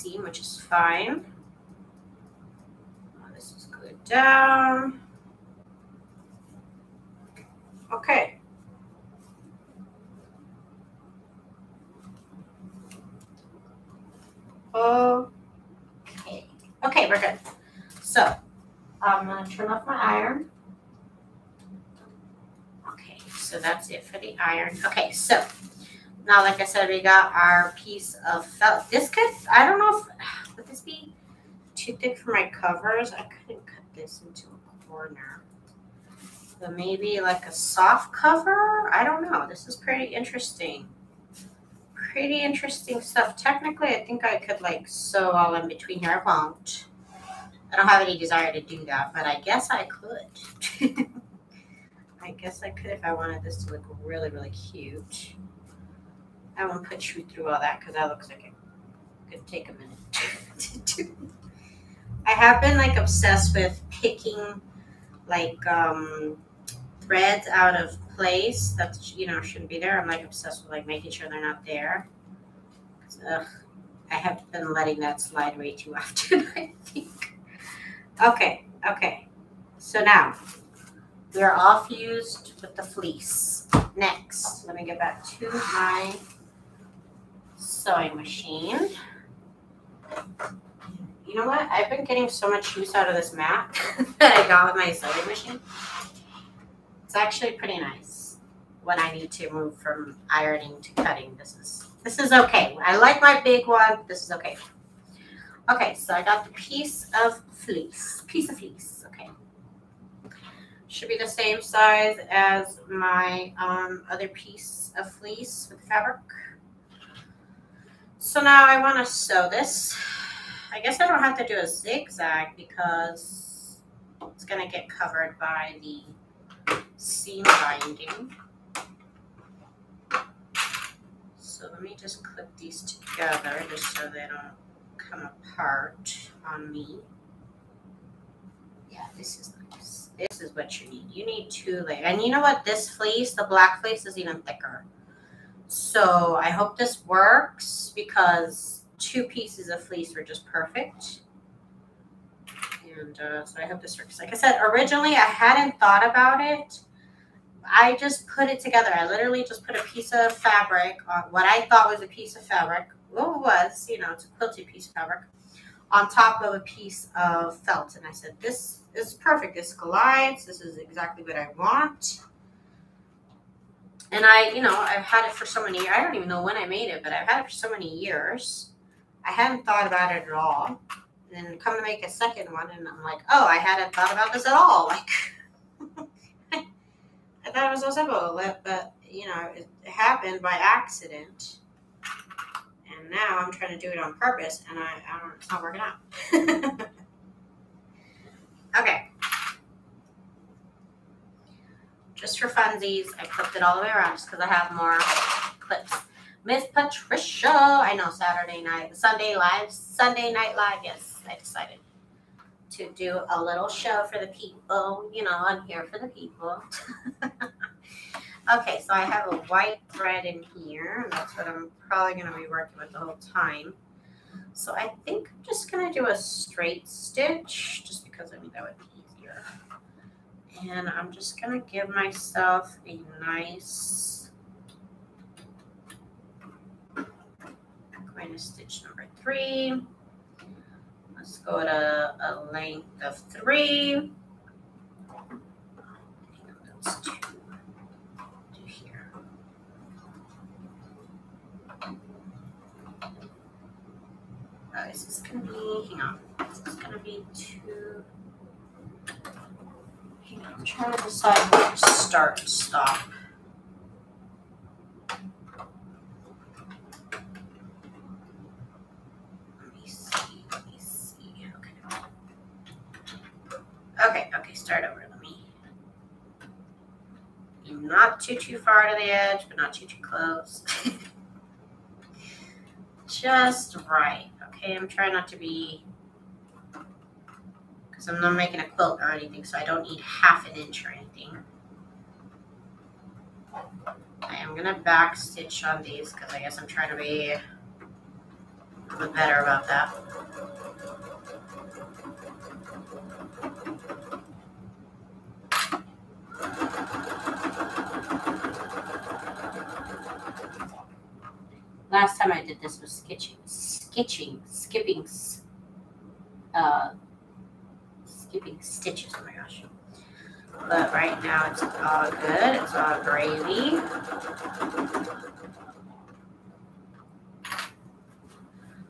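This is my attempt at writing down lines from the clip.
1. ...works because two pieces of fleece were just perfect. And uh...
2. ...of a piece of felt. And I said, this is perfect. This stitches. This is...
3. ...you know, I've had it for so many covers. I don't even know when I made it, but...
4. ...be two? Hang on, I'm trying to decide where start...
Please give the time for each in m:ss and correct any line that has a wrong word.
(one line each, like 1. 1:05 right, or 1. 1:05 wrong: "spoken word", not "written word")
1. 2:27 right
2. 2:46 wrong: "collides", not "stitches"
3. 2:54 wrong: "years", not "covers"
4. 4:16 right.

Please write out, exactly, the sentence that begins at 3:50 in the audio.
And I'm just going to give myself a nice minus stitch number three.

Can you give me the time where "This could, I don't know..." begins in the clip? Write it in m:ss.
0:28.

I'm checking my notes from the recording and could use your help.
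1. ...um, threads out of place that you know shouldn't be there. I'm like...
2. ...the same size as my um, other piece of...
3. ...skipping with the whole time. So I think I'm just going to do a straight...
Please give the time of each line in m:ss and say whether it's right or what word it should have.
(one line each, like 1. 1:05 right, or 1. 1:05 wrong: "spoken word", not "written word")
1. 1:05 right
2. 1:51 right
3. 3:42 wrong: "working", not "skipping".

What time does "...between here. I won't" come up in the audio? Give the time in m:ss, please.
0:45.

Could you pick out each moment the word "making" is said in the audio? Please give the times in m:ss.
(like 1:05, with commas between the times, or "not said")
1:10, 4:48.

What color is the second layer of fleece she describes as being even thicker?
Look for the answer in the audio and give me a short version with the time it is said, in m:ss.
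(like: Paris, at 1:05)
black, at 2:23.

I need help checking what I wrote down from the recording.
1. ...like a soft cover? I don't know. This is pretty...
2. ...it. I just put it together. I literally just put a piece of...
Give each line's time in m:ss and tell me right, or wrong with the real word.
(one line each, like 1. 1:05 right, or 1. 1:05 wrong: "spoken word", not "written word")
1. 0:37 right
2. 2:36 right.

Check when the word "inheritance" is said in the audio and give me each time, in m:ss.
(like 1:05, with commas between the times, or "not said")
not said.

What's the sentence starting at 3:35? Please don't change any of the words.
You know, I'm here for the people.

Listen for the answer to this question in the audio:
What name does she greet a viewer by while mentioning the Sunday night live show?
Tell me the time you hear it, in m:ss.
3:26.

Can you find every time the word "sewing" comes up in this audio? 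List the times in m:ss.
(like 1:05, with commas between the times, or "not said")
1:27, 1:34.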